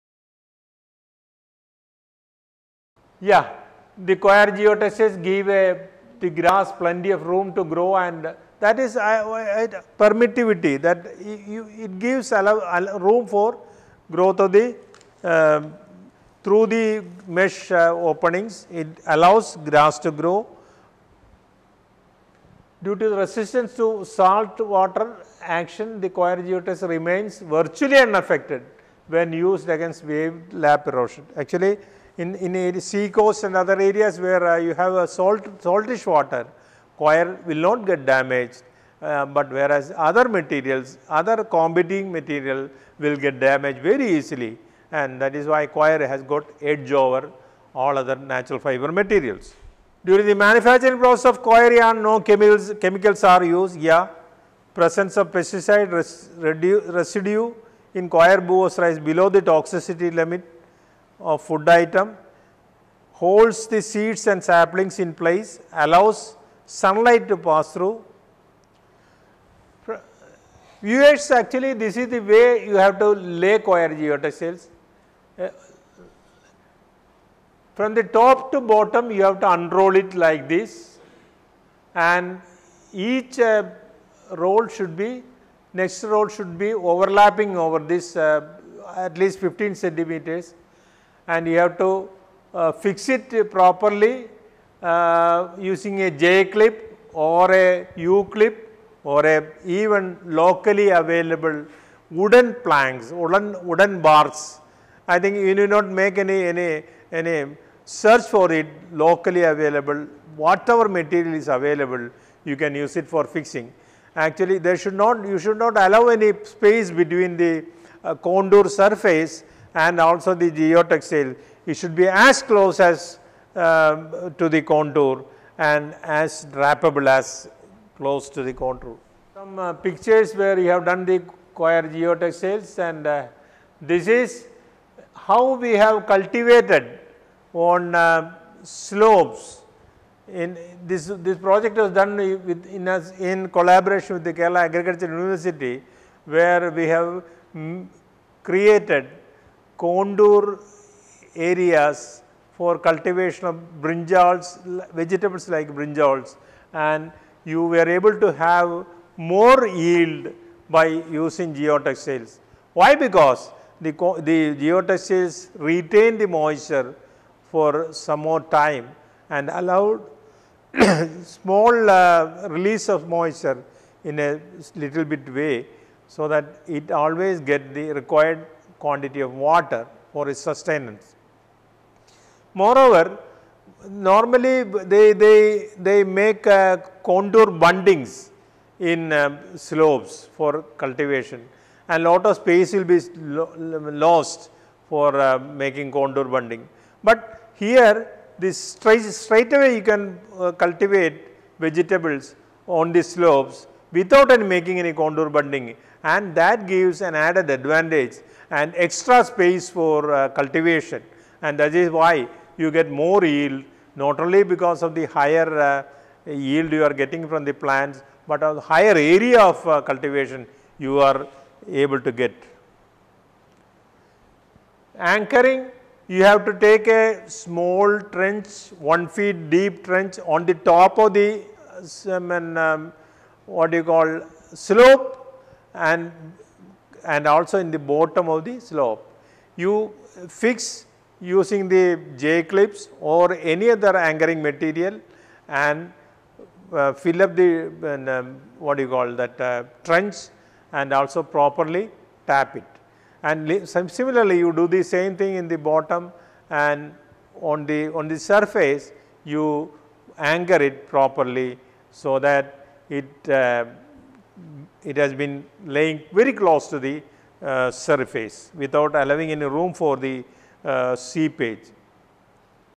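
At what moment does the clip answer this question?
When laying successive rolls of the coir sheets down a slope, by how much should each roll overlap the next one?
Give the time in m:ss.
1:29.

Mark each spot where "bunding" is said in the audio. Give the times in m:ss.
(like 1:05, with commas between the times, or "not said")
3:07, 3:16, 3:25.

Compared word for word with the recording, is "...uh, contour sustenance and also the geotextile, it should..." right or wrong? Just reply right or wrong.
wrong.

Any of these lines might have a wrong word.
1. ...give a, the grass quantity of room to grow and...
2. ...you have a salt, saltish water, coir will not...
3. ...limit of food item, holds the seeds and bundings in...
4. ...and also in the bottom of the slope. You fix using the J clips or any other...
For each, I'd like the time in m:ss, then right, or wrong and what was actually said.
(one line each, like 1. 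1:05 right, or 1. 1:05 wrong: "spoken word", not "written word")
1. 0:05 wrong: "plenty", not "quantity"
2. 0:34 right
3. 1:00 wrong: "saplings", not "bundings"
4. 3:57 right.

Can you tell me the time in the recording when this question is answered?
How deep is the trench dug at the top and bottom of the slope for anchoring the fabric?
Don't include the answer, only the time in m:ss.
3:48.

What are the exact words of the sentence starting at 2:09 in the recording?
Some uh, pictures where you have done the coir geotextiles and uh, this is how we have cultivated on uh, slopes.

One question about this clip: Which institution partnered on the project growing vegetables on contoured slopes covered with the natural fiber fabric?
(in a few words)
Kerala Agricultural University.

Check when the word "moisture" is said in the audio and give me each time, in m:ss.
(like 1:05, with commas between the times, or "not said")
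2:46, 2:53.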